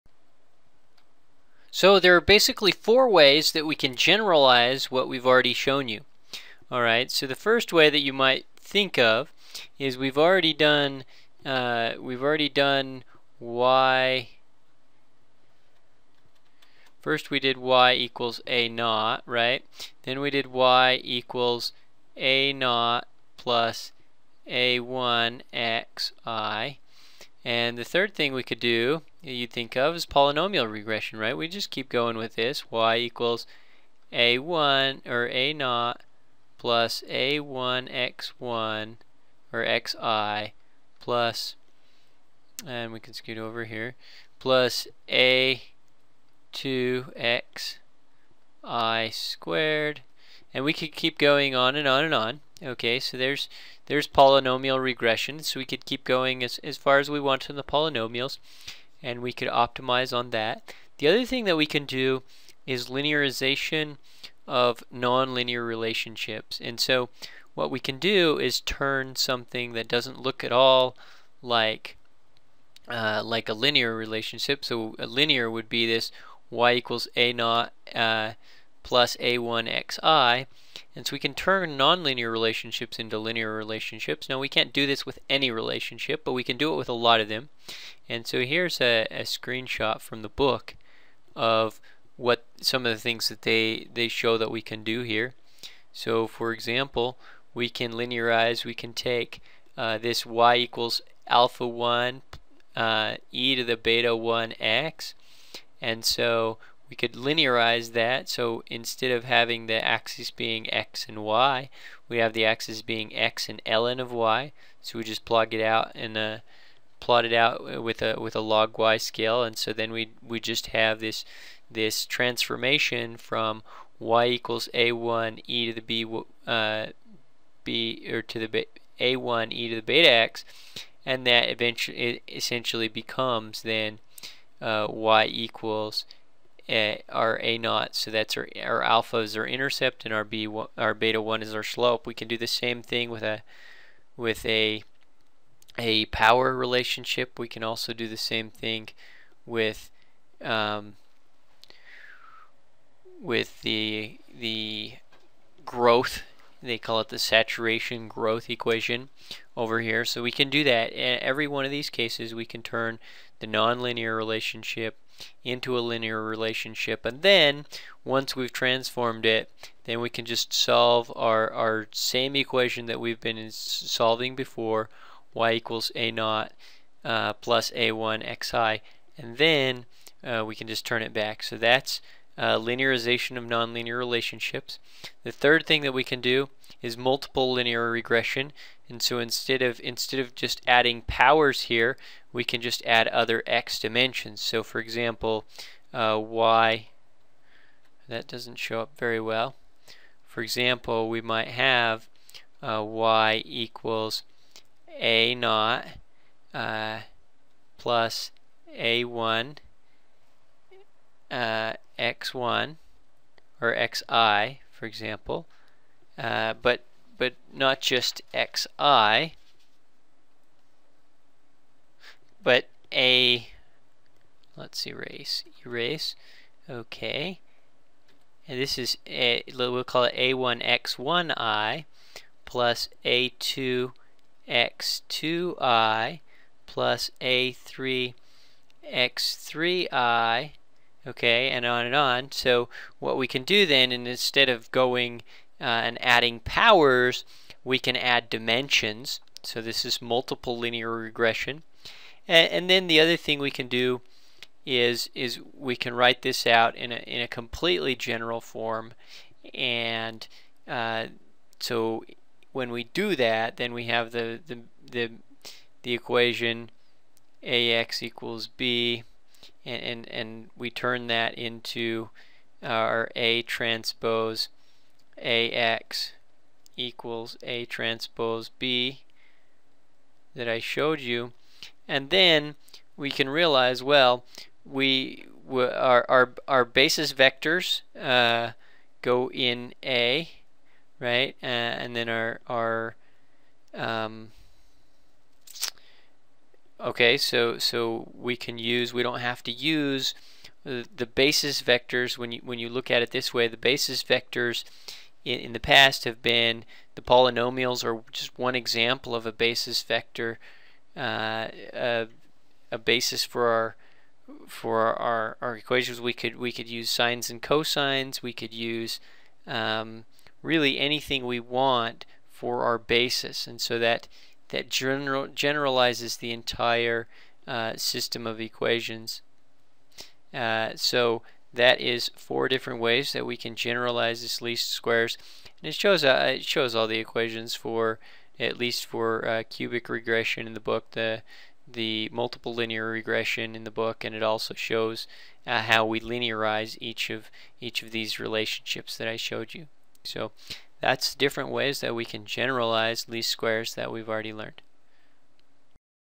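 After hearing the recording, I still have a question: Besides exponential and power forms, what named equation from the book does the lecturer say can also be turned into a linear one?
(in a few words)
saturation growth equation.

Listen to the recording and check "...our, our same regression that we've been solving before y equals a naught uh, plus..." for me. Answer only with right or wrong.
wrong.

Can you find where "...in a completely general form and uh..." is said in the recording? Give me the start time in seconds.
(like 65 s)
256 s.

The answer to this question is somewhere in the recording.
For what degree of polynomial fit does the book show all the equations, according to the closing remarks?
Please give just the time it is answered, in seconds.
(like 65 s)
339 s.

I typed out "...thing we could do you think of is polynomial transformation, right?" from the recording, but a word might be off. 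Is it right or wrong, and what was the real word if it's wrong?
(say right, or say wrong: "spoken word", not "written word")
wrong: "regression", not "transformation".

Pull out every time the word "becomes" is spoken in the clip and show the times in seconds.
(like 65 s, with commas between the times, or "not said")
132 s.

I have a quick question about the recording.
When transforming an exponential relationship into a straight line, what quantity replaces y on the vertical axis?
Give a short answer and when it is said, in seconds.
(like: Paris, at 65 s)
ln of y, at 113 s.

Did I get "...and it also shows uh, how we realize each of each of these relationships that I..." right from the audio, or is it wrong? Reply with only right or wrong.
wrong.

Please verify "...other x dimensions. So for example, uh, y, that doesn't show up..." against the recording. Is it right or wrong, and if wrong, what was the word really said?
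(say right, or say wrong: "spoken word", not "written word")
right.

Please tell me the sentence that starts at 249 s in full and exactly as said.
So this is multiple linear regression.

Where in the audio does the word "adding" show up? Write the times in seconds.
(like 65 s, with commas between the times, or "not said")
190 s, 246 s.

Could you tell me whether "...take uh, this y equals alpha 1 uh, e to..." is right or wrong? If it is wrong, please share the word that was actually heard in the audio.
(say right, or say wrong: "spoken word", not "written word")
right.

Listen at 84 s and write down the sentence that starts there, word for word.
Now we can't do this with any relationship, but we can do it with a lot of them.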